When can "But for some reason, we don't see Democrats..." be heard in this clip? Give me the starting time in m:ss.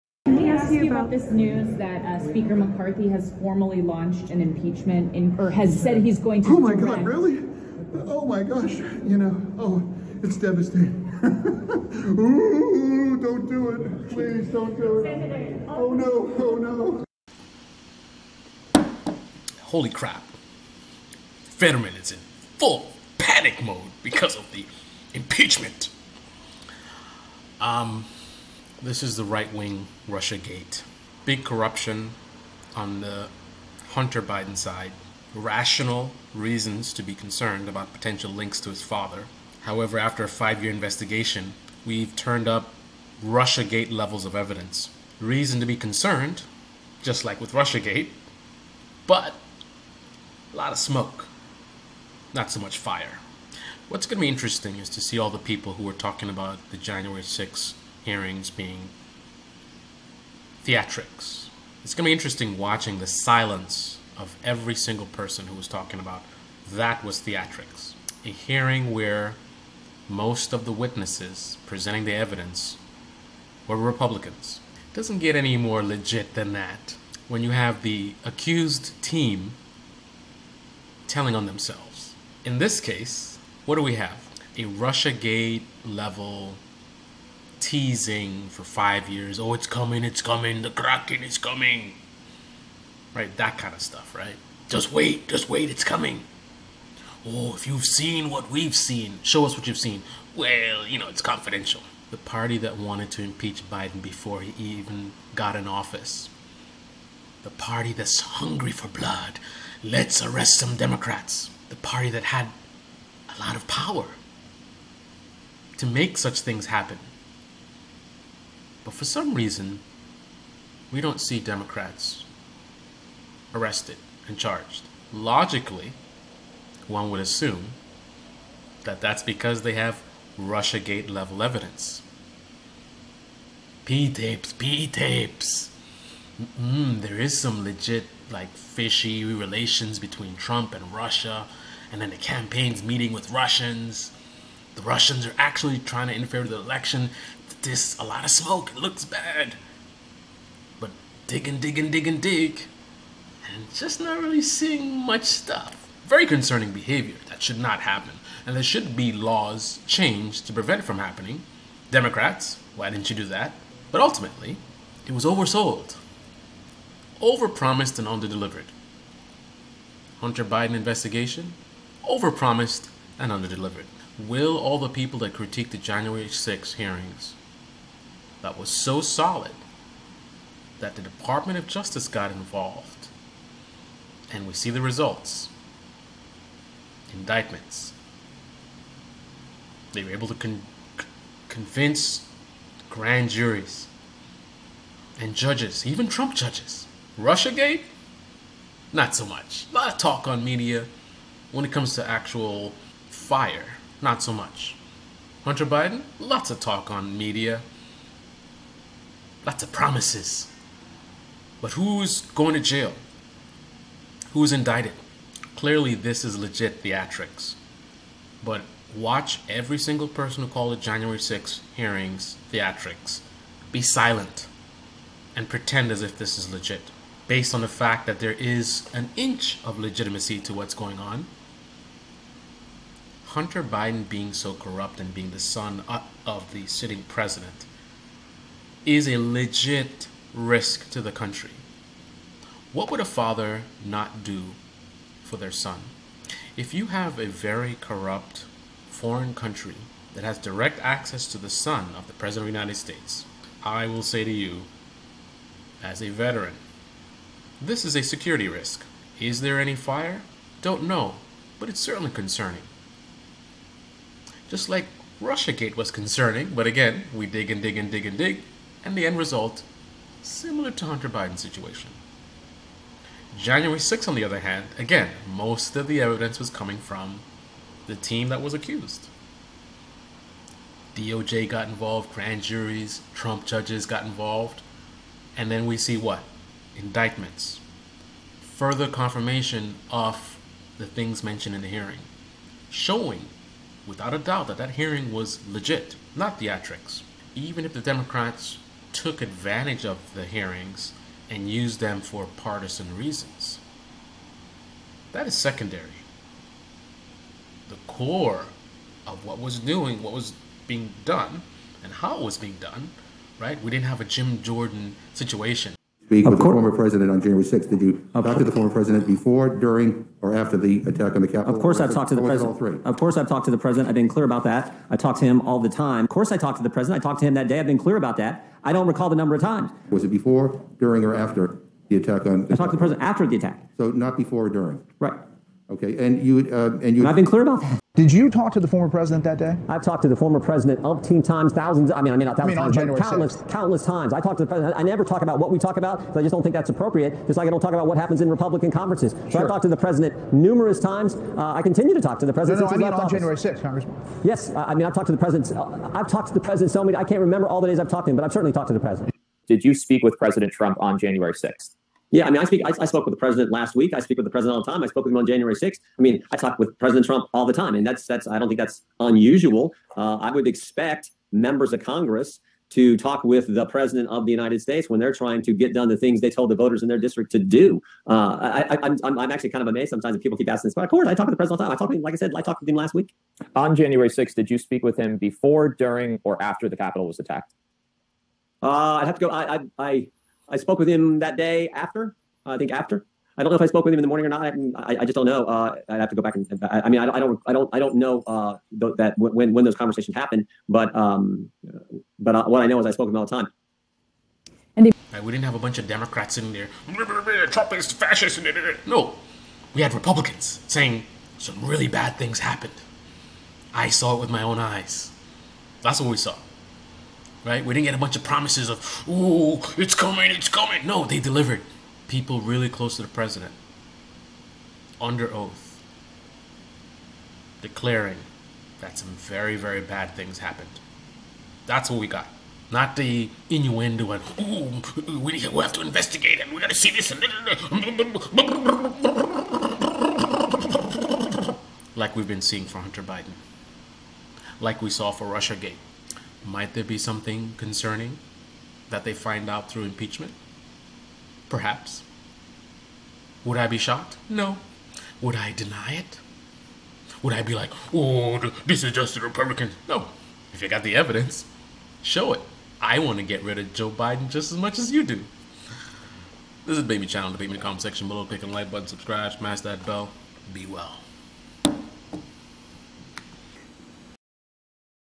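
1:58.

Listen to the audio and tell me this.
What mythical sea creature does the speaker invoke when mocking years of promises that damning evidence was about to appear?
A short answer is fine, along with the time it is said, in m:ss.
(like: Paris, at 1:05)
Kraken, at 1:30.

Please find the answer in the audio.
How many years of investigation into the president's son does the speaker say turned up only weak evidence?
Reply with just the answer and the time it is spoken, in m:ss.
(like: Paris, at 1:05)
5, at 0:40.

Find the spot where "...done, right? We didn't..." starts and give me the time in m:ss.
5:12.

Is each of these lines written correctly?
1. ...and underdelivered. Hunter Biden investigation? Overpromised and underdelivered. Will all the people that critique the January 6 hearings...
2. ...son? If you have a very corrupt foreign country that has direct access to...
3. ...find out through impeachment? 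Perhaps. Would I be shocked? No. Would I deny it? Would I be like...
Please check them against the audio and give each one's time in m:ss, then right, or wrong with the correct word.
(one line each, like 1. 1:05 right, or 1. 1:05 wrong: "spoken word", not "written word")
1. 2:47 right
2. 4:05 right
3. 7:29 right.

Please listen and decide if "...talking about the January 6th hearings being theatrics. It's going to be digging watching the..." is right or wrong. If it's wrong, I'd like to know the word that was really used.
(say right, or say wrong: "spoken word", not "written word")
wrong: "interesting", not "digging".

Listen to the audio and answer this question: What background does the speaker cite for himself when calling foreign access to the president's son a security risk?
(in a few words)
Veteran.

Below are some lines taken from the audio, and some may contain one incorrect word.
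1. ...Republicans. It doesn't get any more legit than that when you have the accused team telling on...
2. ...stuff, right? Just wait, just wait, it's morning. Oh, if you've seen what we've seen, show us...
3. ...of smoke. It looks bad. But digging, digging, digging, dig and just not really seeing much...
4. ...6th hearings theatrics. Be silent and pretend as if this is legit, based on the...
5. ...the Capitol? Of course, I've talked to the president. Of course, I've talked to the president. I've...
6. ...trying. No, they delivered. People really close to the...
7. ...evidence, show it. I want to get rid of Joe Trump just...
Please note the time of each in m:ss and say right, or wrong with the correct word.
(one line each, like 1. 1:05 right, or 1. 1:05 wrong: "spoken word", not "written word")
1. 1:13 right
2. 1:33 wrong: "coming", not "morning"
3. 2:28 right
4. 3:41 right
5. 5:21 right
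6. 7:00 wrong: "coming", not "trying"
7. 7:40 wrong: "Biden", not "Trump".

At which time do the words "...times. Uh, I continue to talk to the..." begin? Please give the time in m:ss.
5:50.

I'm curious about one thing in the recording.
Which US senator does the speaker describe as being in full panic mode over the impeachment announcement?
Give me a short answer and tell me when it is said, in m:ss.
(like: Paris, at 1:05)
Fetterman, at 0:21.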